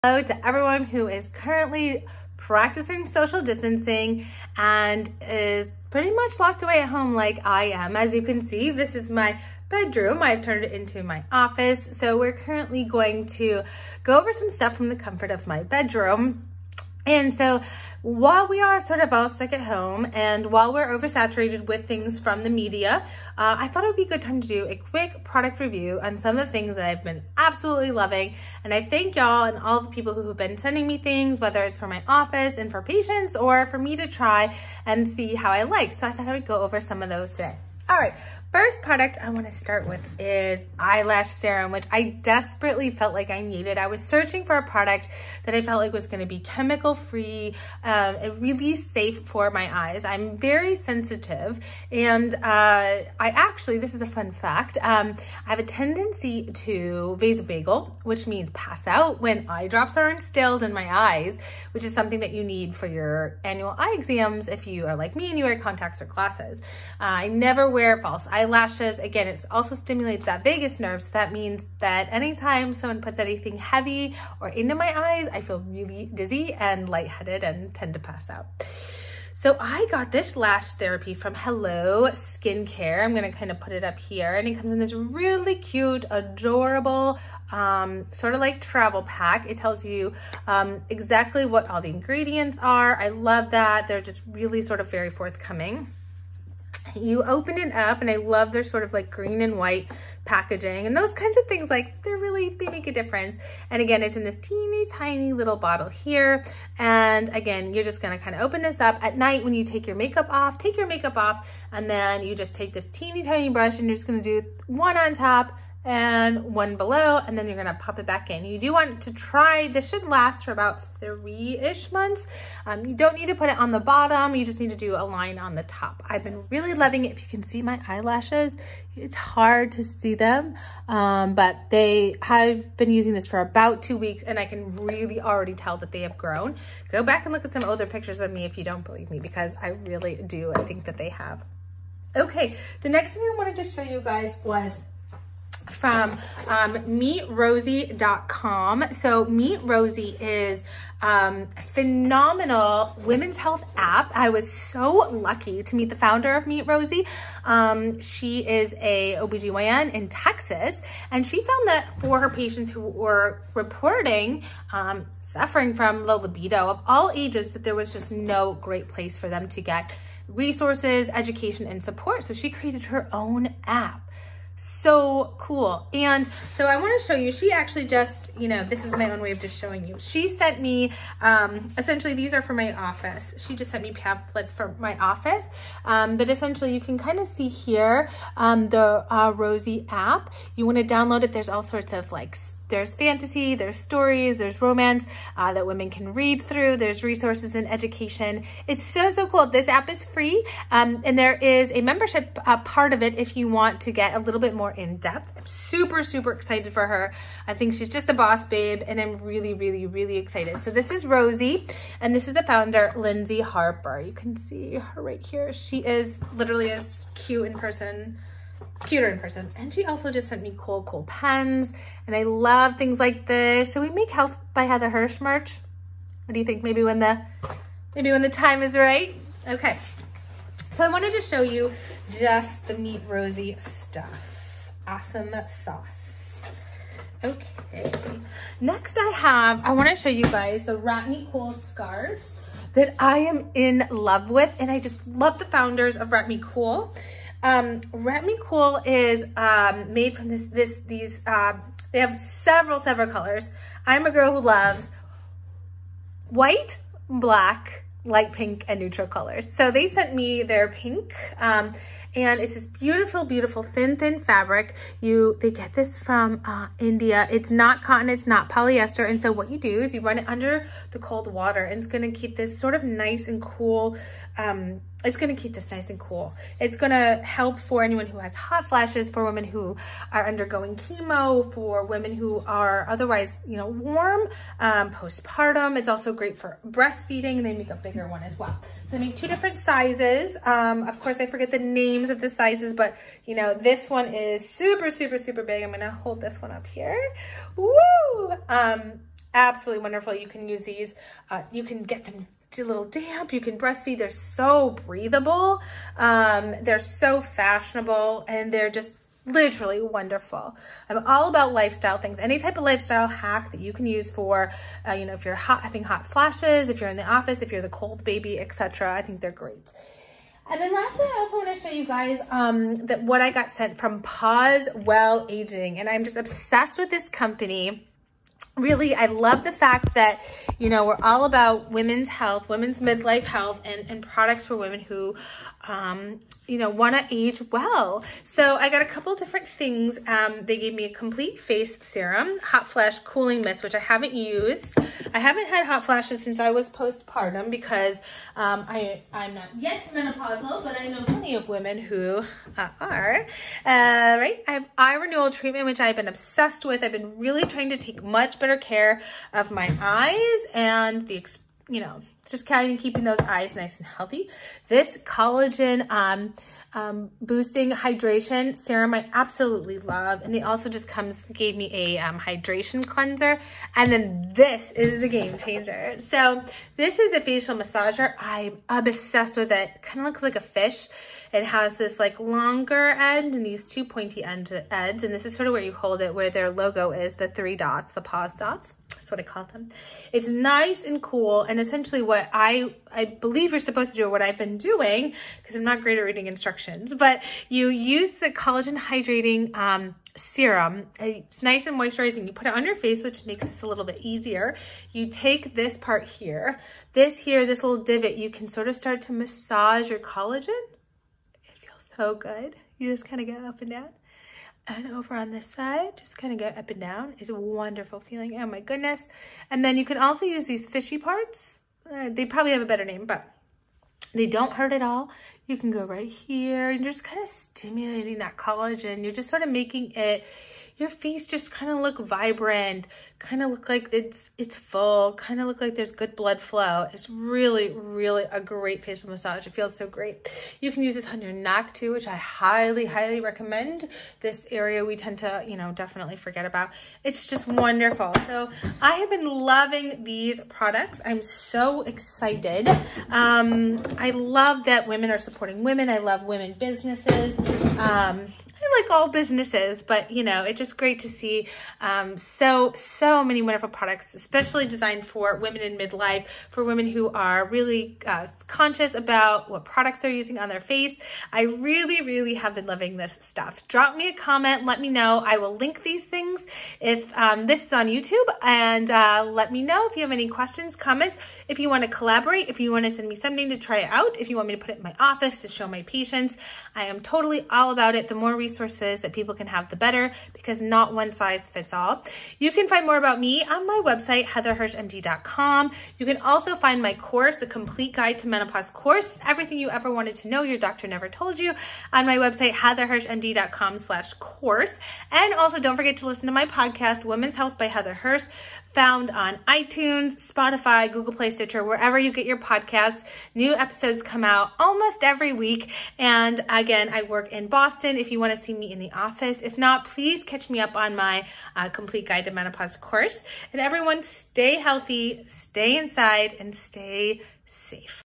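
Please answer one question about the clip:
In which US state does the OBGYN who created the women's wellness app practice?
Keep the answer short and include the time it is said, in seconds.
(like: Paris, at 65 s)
Texas, at 160 s.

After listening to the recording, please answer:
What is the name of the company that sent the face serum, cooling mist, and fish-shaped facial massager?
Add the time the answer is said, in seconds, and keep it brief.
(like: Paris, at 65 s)
Pause Well Aging, at 324 s.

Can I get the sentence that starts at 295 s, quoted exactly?
I'm going to hold this one up here.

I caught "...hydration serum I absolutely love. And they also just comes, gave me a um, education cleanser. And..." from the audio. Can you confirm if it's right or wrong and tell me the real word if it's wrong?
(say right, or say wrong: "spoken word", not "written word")
wrong: "hydration", not "education".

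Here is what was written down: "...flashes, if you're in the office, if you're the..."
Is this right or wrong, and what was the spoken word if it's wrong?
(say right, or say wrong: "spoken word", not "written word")
right.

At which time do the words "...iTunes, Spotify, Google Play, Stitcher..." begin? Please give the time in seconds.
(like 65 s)
509 s.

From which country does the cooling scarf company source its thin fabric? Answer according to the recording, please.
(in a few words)
India.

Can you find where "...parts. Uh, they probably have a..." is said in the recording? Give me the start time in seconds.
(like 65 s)
420 s.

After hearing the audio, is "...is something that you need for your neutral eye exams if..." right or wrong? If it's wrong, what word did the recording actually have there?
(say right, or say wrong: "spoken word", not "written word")
wrong: "annual", not "neutral".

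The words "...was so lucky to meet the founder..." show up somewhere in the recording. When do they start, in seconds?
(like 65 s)
154 s.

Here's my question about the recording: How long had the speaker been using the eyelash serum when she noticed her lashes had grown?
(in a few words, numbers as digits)
2 weeks.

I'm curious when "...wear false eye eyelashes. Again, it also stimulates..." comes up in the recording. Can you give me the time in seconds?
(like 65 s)
67 s.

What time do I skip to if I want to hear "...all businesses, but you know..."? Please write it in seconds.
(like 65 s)
458 s.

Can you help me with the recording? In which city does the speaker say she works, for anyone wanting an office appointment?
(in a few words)
Boston.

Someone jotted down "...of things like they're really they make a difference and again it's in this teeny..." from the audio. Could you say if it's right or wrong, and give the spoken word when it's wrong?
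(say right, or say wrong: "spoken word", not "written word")
right.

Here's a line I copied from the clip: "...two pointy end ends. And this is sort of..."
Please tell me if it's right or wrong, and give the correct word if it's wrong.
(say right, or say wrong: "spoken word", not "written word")
right.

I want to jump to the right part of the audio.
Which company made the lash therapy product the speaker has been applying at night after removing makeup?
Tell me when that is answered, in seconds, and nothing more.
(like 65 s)
81 s.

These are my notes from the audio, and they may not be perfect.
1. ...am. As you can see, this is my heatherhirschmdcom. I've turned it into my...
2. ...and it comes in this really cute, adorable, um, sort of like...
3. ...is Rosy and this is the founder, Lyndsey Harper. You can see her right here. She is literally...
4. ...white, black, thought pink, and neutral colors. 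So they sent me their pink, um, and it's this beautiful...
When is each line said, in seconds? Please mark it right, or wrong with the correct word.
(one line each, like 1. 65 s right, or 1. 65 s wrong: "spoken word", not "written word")
1. 7 s wrong: "bedroom", not "heatherhirschmdcom"
2. 84 s right
3. 210 s right
4. 256 s wrong: "light", not "thought".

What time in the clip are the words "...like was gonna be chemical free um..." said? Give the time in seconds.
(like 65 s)
45 s.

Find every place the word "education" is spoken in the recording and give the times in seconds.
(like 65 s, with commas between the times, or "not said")
171 s, 197 s.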